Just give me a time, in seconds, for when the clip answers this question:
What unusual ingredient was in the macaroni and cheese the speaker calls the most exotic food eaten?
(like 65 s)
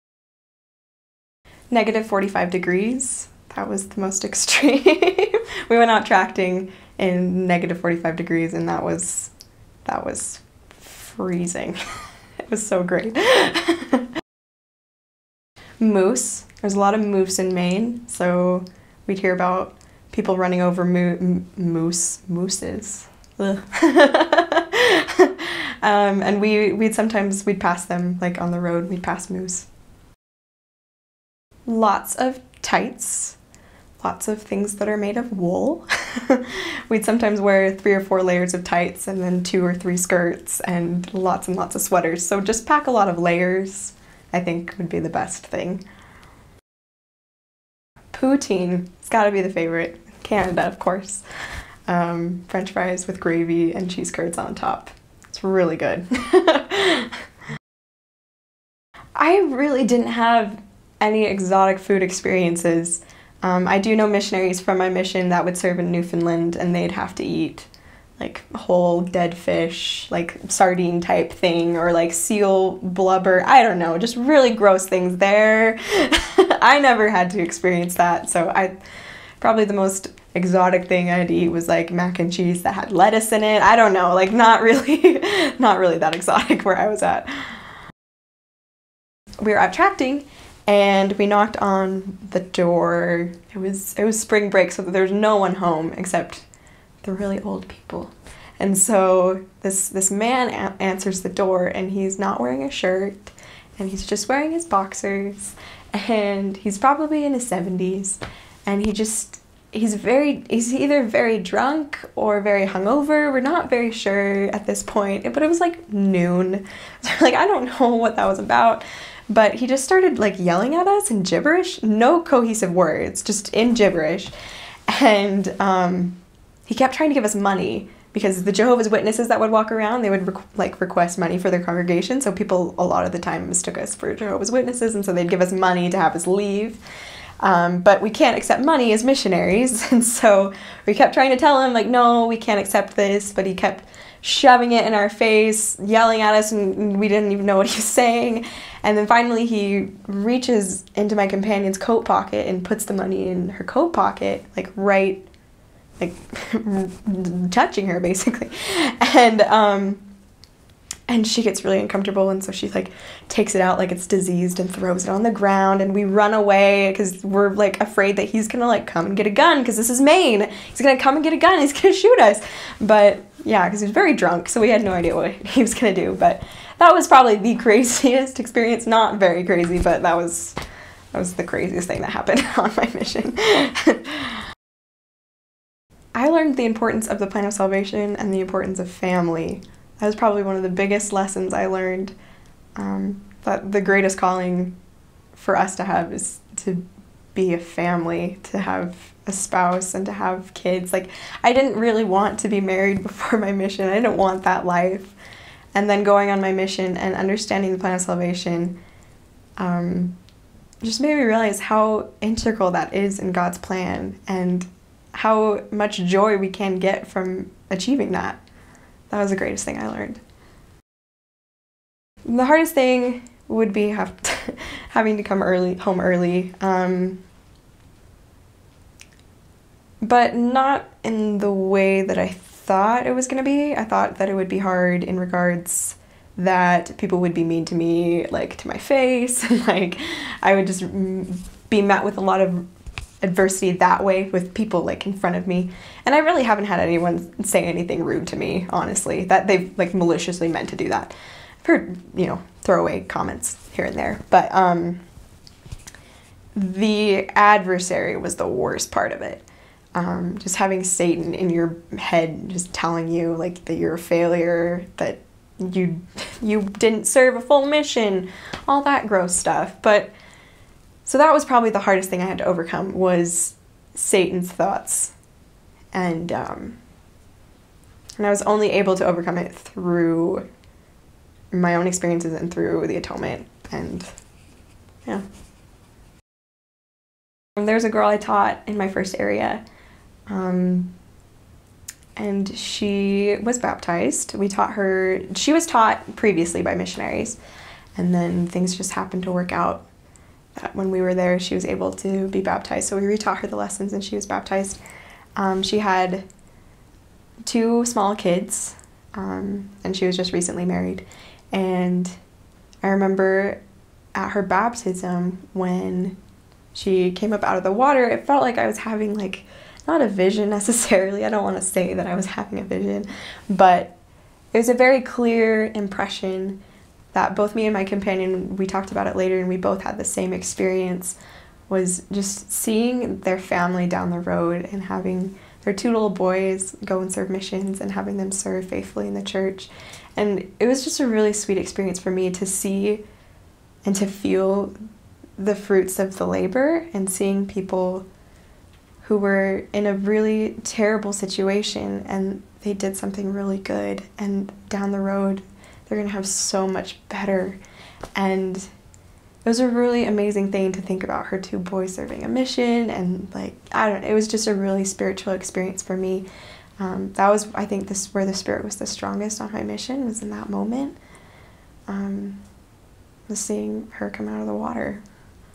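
82 s.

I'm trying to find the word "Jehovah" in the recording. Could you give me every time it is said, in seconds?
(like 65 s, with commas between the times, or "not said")
128 s, 134 s.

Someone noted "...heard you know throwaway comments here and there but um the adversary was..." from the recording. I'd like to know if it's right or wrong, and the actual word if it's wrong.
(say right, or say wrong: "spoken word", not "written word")
right.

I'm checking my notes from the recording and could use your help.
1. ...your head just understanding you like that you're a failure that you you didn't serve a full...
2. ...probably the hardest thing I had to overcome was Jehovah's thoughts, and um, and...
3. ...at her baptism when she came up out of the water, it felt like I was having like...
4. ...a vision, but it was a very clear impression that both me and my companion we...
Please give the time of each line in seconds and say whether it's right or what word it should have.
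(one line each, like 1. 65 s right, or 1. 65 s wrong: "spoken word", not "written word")
1. 261 s wrong: "telling", not "understanding"
2. 271 s wrong: "Satan", not "Jehovah"
3. 314 s right
4. 322 s right.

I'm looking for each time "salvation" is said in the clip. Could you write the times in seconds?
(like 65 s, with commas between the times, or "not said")
187 s, 208 s.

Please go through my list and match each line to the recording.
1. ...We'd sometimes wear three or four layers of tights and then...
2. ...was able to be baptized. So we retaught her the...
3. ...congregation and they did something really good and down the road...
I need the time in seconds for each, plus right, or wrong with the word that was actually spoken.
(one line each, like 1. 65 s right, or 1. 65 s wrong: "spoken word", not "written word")
1. 36 s right
2. 301 s right
3. 351 s wrong: "situation", not "congregation".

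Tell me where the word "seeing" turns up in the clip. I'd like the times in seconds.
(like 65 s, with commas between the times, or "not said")
332 s, 347 s, 373 s.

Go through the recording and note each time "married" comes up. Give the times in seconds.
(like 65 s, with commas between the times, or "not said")
202 s, 310 s.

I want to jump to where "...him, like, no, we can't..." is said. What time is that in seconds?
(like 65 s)
141 s.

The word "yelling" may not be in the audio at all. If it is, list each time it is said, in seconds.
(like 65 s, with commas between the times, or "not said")
120 s, 145 s.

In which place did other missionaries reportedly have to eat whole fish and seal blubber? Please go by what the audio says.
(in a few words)
Newfoundland.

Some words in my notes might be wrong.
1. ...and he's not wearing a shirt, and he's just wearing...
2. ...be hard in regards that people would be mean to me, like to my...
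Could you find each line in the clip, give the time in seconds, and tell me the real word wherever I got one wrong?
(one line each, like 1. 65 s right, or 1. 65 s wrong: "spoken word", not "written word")
1. 101 s right
2. 234 s right.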